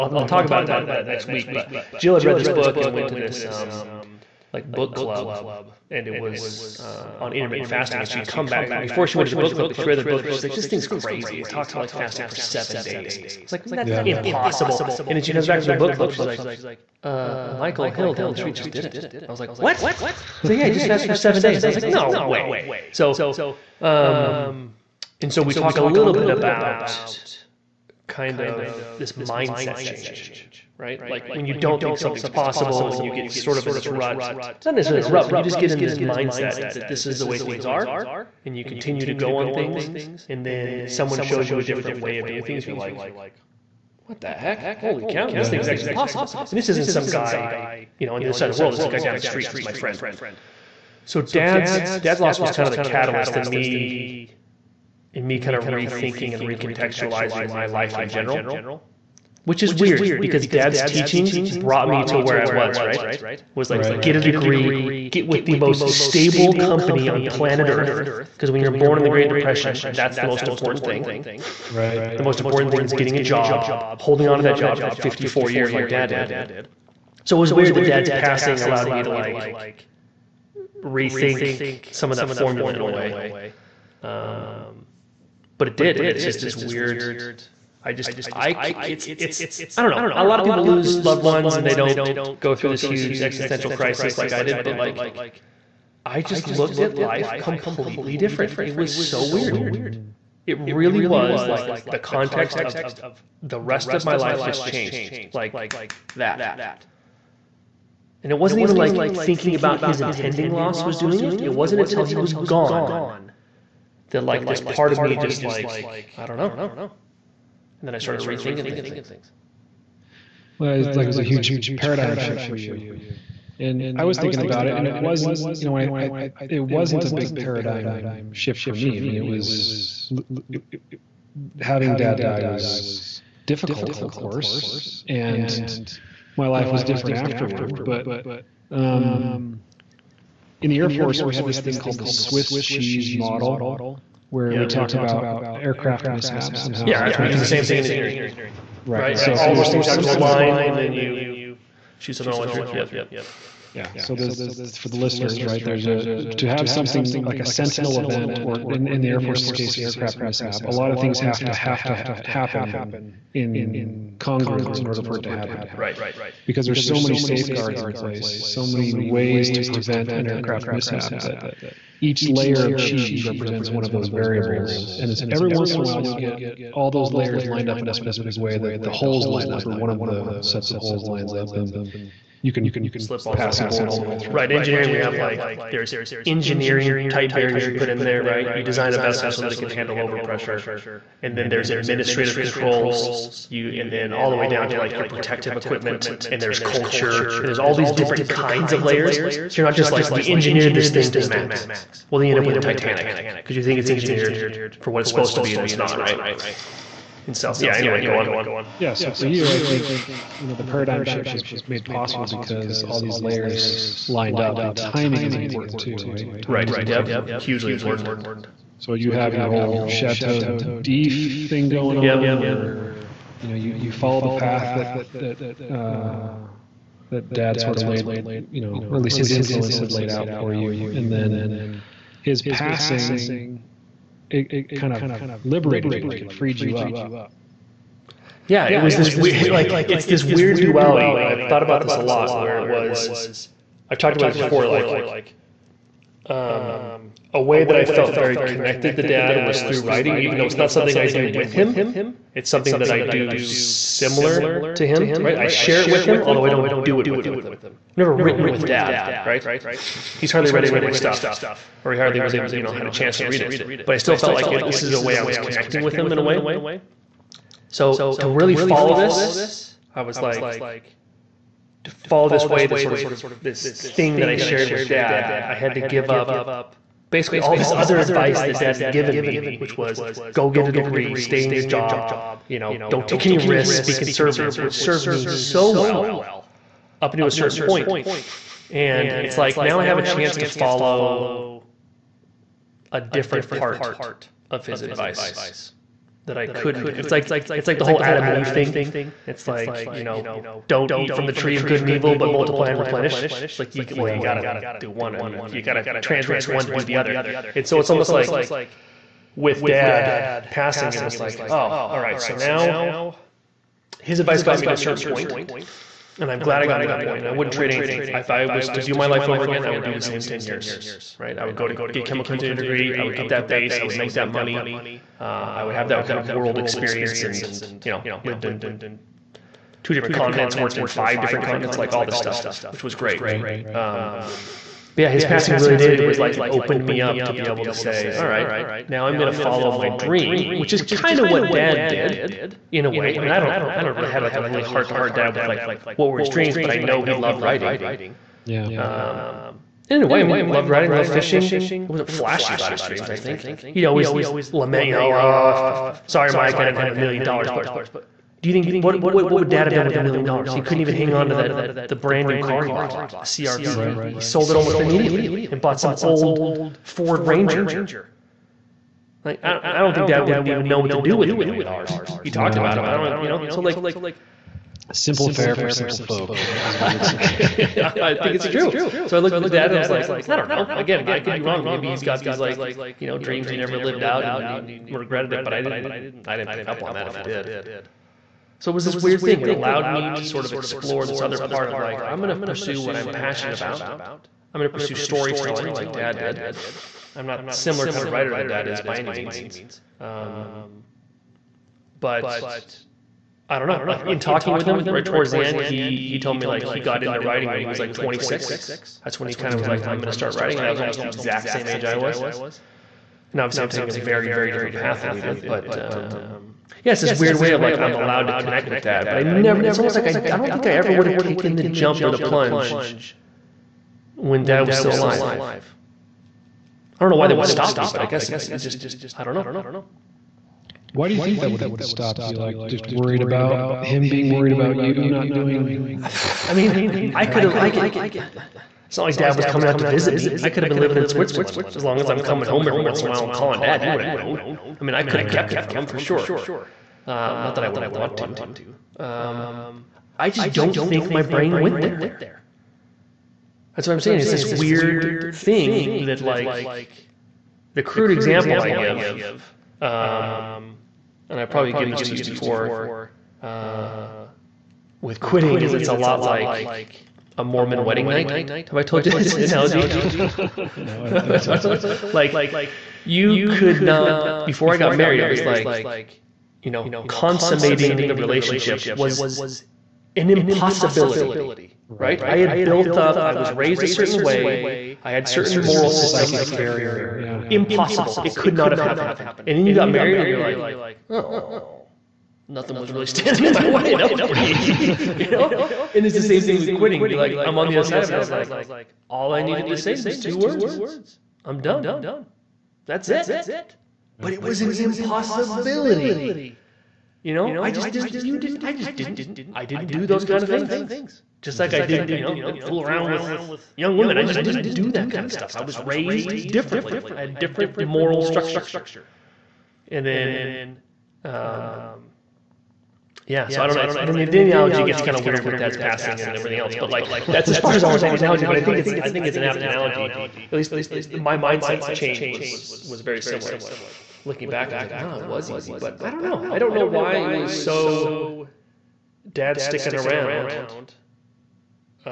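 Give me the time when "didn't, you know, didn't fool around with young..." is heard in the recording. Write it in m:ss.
8:31.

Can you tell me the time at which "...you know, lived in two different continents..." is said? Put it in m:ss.
5:27.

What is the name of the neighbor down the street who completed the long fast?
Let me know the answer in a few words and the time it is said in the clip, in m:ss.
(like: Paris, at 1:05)
Michael Hill, at 0:17.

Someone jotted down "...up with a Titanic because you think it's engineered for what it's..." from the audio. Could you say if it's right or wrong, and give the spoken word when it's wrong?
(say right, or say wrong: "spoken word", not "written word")
right.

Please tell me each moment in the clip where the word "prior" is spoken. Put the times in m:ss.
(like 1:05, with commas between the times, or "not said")
not said.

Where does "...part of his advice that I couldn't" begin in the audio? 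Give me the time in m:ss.
4:53.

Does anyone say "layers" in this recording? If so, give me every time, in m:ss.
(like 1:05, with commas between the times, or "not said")
2:52, 2:57, 3:18, 3:33.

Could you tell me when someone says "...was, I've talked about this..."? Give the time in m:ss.
4:02.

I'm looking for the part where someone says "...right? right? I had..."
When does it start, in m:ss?
8:01.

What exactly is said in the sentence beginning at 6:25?
But I didn't, I didn't pick up on that if he did.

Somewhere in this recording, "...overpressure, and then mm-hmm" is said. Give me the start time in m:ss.
3:09.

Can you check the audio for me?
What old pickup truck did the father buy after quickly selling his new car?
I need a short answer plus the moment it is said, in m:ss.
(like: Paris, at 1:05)
Ford Ranger, at 6:06.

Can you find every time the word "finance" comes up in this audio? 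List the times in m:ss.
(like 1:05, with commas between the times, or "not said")
not said.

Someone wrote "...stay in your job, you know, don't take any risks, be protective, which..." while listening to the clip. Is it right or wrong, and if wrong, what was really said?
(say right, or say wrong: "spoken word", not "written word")
wrong: "conservative", not "protective".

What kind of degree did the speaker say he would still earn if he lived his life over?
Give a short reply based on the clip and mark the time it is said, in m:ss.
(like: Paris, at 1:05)
Chemical engineering, at 5:22.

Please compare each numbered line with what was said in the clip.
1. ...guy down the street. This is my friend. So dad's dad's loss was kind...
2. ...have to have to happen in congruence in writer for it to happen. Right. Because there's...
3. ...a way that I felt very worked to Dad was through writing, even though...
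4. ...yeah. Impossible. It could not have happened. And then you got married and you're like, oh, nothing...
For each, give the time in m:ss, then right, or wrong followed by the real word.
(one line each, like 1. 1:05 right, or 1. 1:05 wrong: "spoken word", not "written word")
1. 0:48 right
2. 2:41 wrong: "order", not "writer"
3. 4:07 wrong: "connected", not "worked"
4. 8:07 right.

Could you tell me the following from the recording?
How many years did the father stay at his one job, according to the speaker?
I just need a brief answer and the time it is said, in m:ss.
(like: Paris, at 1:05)
54, at 1:14.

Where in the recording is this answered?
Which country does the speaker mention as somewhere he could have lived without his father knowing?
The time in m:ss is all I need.
7:21.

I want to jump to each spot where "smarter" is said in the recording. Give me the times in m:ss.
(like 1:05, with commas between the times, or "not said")
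not said.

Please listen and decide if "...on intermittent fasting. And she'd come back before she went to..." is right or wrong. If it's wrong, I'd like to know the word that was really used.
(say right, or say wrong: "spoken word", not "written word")
right.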